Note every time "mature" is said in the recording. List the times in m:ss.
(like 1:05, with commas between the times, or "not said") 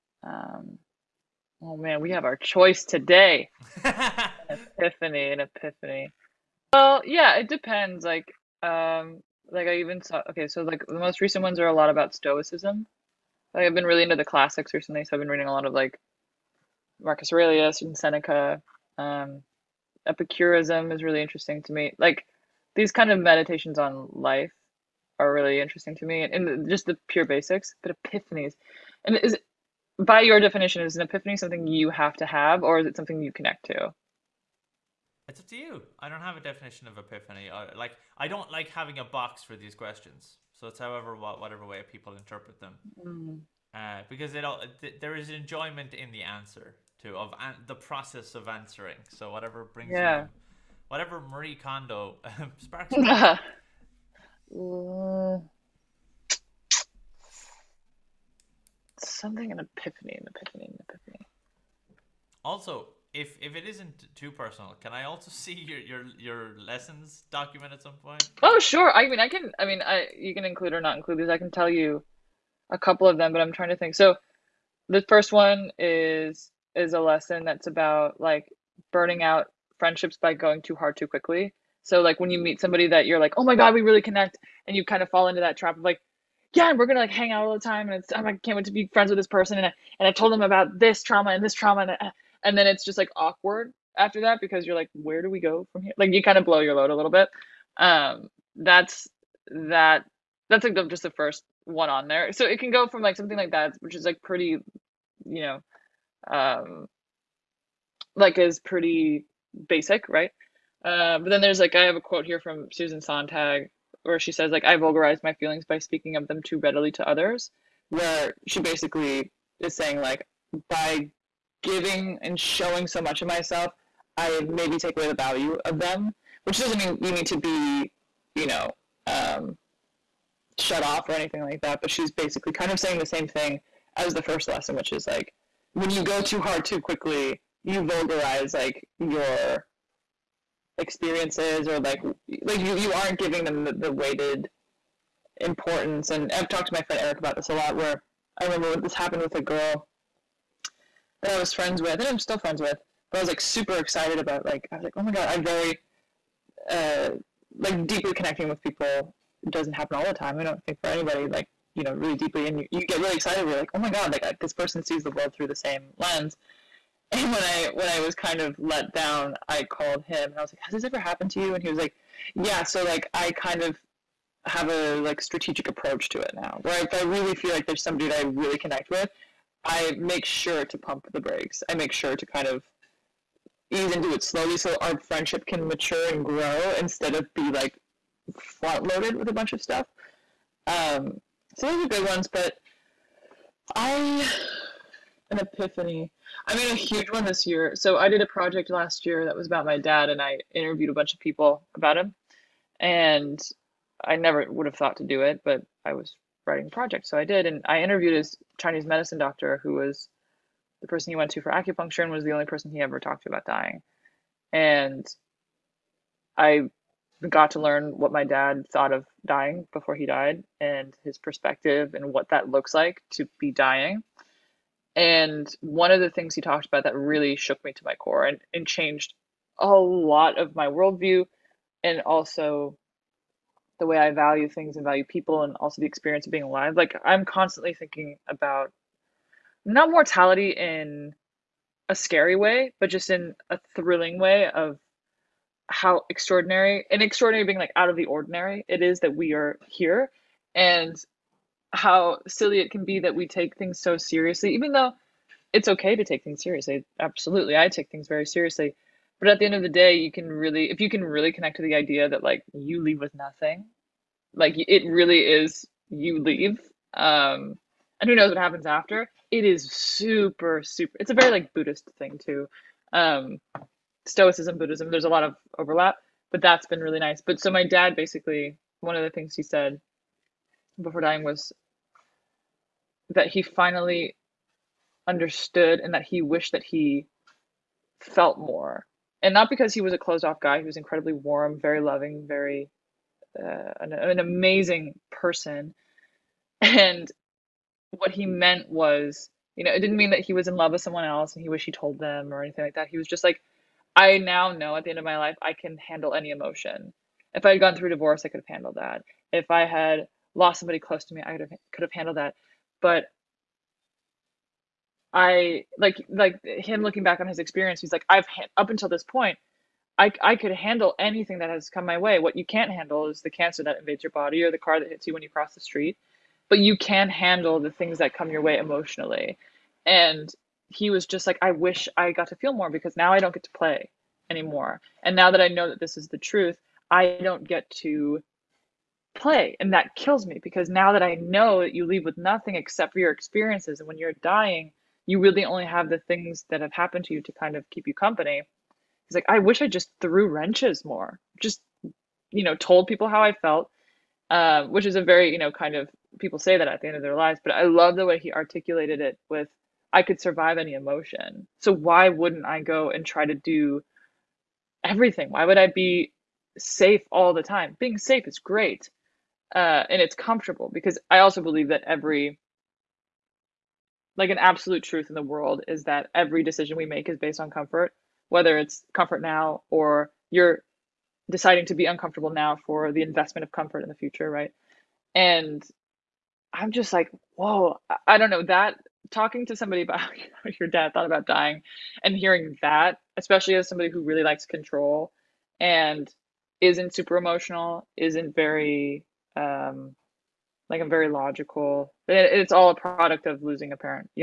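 3:05.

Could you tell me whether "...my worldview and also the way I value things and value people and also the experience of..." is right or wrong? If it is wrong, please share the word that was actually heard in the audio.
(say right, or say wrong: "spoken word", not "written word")
right.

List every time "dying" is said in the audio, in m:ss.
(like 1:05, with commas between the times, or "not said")
3:33, 3:39, 3:43, 4:40, 5:44, 6:31.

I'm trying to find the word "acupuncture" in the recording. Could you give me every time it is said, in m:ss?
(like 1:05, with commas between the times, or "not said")
3:31.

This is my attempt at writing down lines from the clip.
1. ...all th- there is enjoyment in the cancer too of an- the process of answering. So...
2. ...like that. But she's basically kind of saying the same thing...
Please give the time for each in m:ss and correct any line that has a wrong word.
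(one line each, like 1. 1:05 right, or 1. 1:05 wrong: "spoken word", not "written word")
1. 0:44 wrong: "answer", not "cancer"
2. 2:11 right.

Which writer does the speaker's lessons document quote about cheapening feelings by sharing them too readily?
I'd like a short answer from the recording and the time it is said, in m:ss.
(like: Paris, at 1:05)
Susan Sontag, at 1:52.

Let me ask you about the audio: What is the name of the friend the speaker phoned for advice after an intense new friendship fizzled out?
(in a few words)
Eric.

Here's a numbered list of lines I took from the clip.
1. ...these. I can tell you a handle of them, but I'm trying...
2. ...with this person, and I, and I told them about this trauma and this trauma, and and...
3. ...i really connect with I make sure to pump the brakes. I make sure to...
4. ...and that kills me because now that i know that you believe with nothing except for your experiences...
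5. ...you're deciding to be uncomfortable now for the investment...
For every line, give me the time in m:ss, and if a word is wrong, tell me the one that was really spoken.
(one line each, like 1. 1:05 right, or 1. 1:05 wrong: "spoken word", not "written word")
1. 1:11 wrong: "couple", not "handle"
2. 1:29 right
3. 2:58 right
4. 5:39 wrong: "leave", not "believe"
5. 6:20 right.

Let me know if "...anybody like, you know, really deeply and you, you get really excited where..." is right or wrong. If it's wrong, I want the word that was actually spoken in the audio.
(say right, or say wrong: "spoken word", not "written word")
right.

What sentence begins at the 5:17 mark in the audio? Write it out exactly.
He's like, I've up until this point, I I could handle anything that has come my way.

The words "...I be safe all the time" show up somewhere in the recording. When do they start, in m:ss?
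6:05.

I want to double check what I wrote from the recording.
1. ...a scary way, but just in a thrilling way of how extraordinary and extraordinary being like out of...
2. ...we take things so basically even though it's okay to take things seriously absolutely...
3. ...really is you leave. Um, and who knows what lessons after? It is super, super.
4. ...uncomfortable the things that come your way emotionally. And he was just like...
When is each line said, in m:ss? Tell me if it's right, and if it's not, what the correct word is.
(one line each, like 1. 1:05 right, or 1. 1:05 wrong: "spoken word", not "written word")
1. 4:01 right
2. 4:13 wrong: "seriously", not "basically"
3. 4:24 wrong: "happens", not "lessons"
4. 5:27 wrong: "handle", not "uncomfortable".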